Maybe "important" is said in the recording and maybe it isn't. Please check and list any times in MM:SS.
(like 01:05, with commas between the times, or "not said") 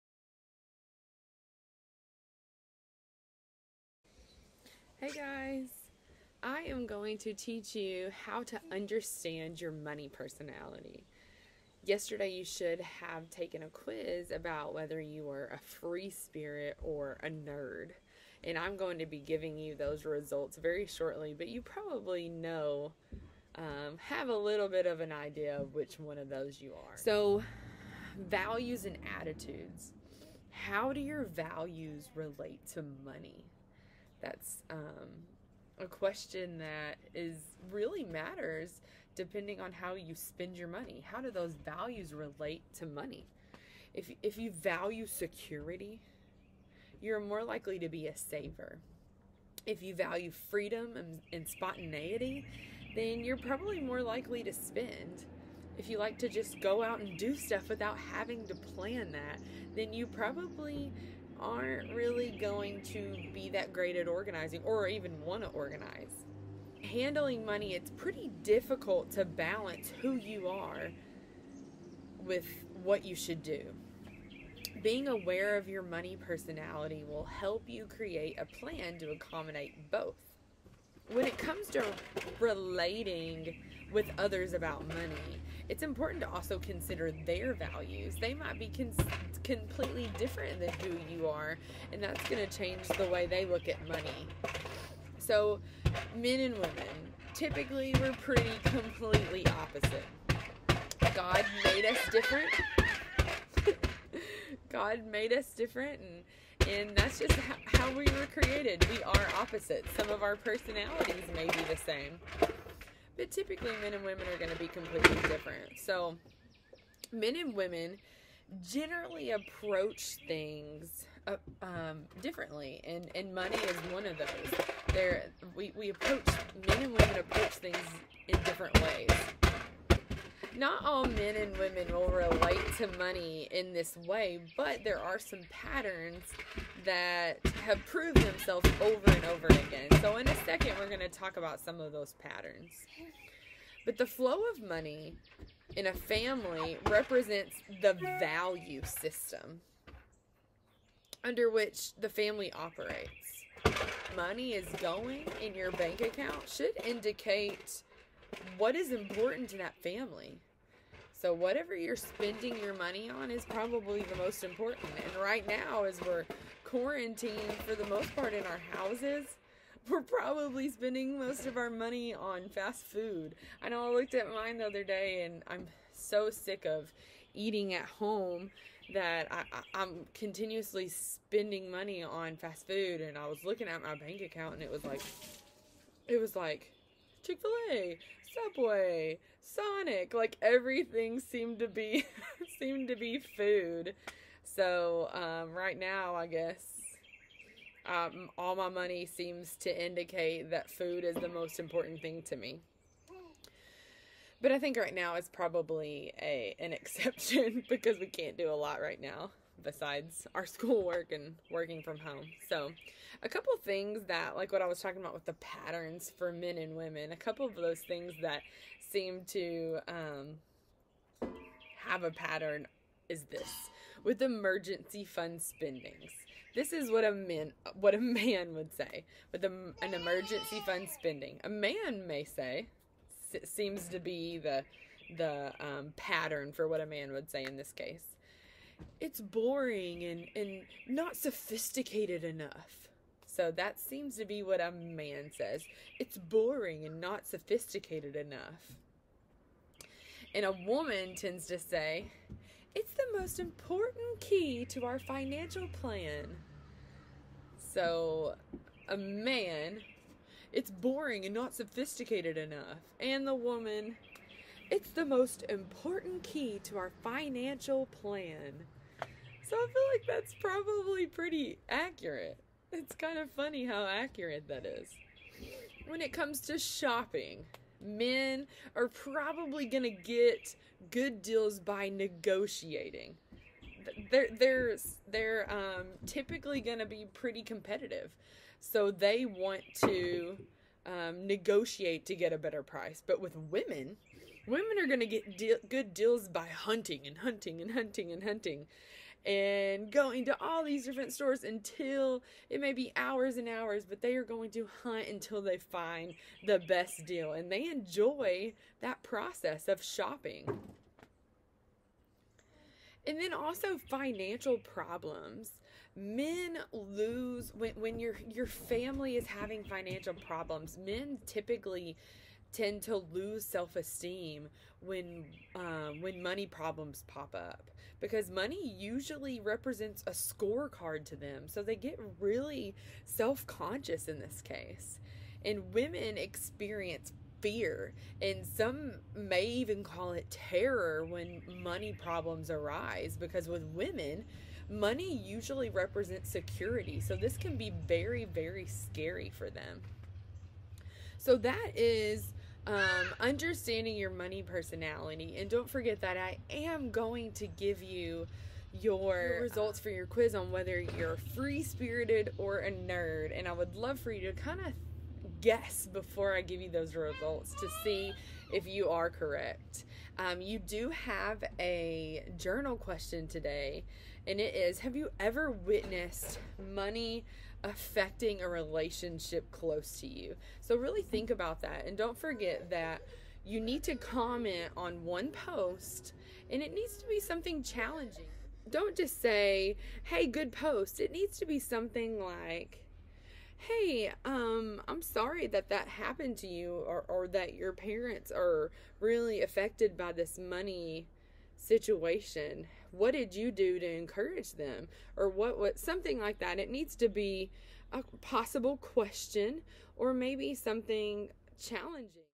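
01:25, 02:38, 02:44, 03:21, 04:13, 04:25.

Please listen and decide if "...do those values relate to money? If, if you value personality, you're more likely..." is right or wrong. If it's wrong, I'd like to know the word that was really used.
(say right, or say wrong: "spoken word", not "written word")
wrong: "security", not "personality".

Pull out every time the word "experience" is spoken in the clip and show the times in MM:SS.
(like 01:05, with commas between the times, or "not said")
05:36.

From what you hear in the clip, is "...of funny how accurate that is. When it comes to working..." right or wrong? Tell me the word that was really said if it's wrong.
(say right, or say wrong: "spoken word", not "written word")
wrong: "shopping", not "working".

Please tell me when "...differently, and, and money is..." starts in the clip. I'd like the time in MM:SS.
02:02.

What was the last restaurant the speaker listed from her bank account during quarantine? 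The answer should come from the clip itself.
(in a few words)
Sonic.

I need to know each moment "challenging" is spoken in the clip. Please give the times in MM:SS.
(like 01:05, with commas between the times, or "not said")
06:27, 06:51.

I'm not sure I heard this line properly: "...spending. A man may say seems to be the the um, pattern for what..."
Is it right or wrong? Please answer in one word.
right.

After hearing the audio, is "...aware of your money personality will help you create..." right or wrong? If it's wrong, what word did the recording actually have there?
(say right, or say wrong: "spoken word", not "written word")
right.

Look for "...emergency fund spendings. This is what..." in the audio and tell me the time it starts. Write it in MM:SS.
03:44.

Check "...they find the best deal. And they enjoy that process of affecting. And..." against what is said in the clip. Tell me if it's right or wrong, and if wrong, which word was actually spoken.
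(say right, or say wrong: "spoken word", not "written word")
wrong: "shopping", not "affecting".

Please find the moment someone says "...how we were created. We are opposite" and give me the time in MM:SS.
01:47.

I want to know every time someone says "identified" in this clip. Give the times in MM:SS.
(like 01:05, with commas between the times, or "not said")
not said.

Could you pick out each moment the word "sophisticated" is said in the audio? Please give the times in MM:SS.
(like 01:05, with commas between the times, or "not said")
04:01, 04:07, 04:21.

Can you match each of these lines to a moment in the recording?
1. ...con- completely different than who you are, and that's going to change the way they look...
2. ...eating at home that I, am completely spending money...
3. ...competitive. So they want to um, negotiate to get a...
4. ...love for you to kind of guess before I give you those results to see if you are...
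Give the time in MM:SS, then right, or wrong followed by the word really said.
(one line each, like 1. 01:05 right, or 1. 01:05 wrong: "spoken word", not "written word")
1. 01:28 right
2. 02:57 wrong: "continuously", not "completely"
3. 04:47 right
4. 06:03 right.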